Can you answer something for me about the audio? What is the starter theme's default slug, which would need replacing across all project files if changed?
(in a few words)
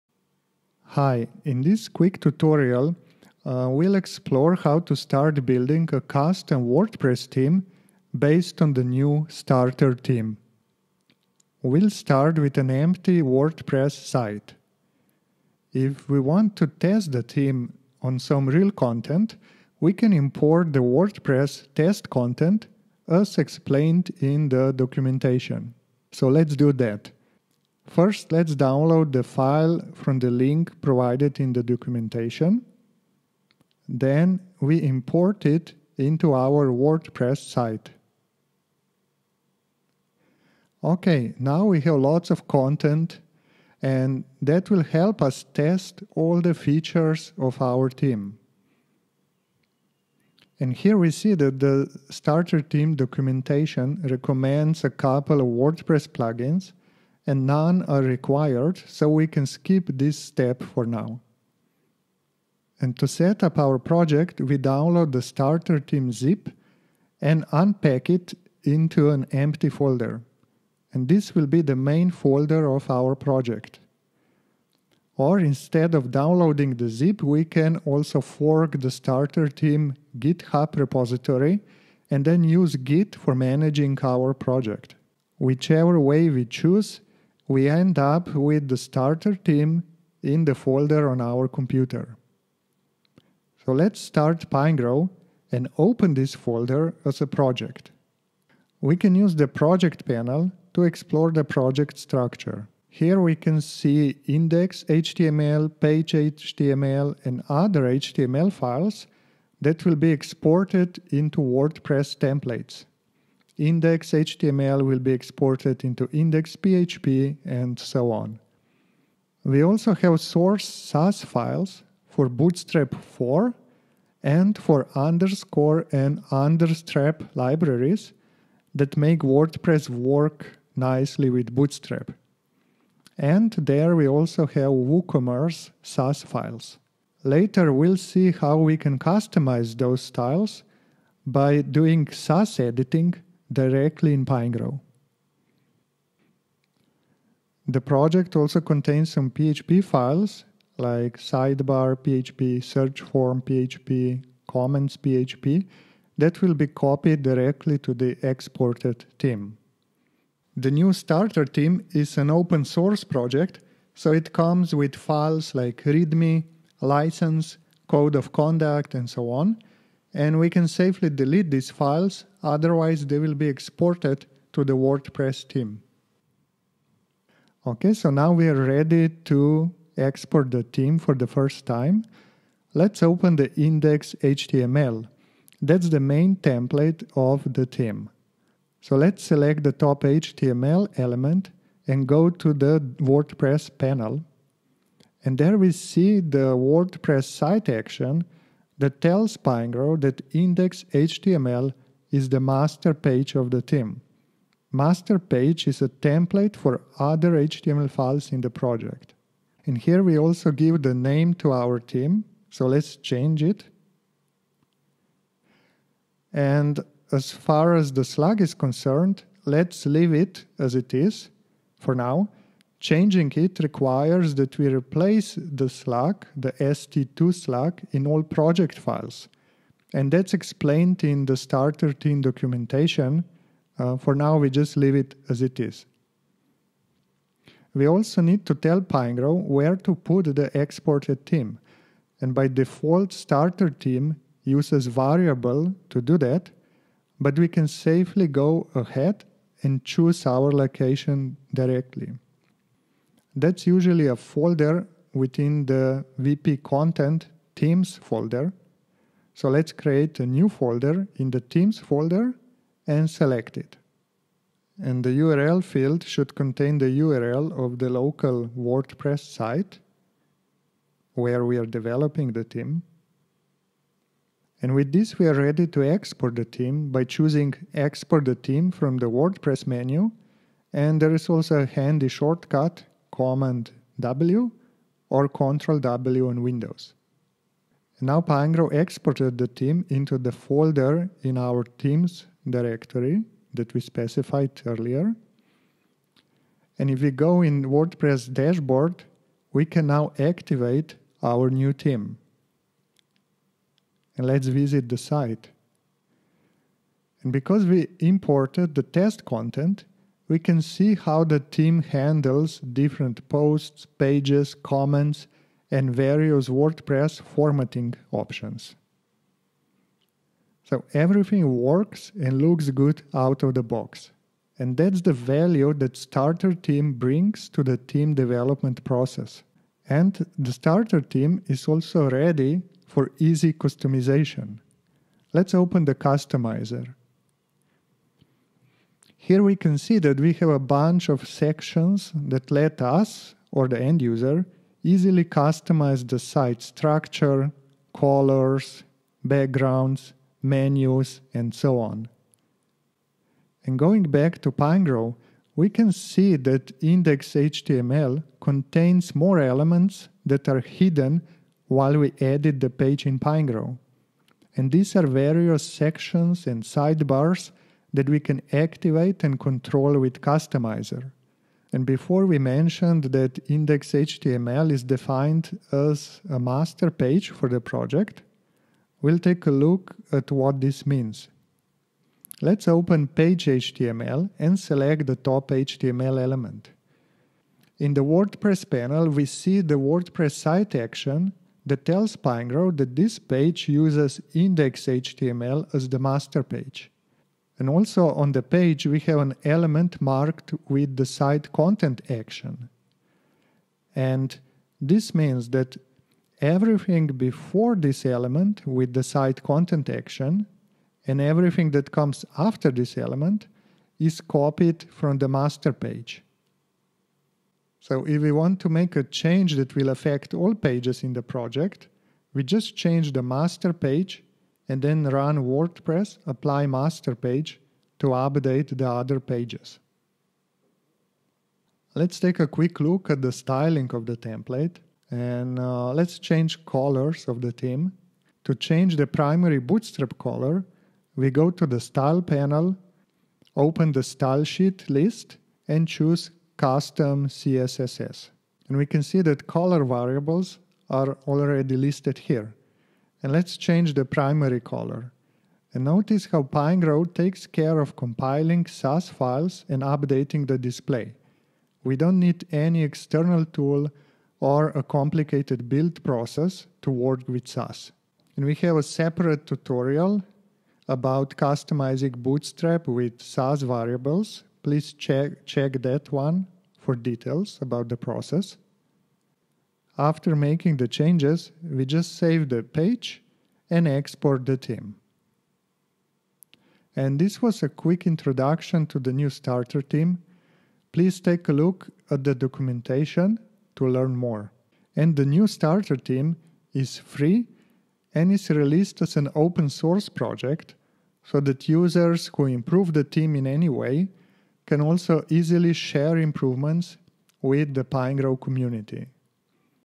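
ST2.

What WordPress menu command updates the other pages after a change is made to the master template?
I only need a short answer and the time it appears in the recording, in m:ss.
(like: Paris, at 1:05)
apply master page, at 7:06.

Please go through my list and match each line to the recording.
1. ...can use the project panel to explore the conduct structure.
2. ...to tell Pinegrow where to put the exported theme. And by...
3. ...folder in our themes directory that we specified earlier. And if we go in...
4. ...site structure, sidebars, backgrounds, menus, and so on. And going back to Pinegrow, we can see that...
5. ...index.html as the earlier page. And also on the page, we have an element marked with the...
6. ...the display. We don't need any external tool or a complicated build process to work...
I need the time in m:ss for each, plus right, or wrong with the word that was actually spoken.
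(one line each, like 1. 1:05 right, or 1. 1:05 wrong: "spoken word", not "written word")
1. 1:38 wrong: "project", not "conduct"
2. 3:58 right
3. 4:50 right
4. 5:46 wrong: "colors", not "sidebars"
5. 6:34 wrong: "master", not "earlier"
6. 7:40 right.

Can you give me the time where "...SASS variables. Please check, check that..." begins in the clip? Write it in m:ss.
7:53.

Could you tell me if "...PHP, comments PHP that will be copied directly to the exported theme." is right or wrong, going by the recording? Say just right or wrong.
right.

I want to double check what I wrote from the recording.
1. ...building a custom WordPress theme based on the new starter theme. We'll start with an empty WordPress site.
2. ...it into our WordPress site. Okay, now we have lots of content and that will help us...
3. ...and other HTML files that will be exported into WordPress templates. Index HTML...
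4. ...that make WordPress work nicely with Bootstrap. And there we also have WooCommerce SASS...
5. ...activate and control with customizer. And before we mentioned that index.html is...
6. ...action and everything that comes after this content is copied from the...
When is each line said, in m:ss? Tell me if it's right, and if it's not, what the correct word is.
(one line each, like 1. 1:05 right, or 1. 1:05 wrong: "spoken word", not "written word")
1. 0:05 right
2. 0:35 right
3. 1:47 right
4. 2:08 right
5. 6:08 right
6. 6:49 wrong: "element", not "content".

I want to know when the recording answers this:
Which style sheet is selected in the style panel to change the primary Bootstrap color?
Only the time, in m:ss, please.
7:26.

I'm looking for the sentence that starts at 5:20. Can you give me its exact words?
So everything works and looks good out of the box.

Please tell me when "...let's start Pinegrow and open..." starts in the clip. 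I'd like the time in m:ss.
1:33.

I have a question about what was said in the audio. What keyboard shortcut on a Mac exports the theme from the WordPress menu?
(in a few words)
Command W.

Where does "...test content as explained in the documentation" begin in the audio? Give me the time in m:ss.
0:21.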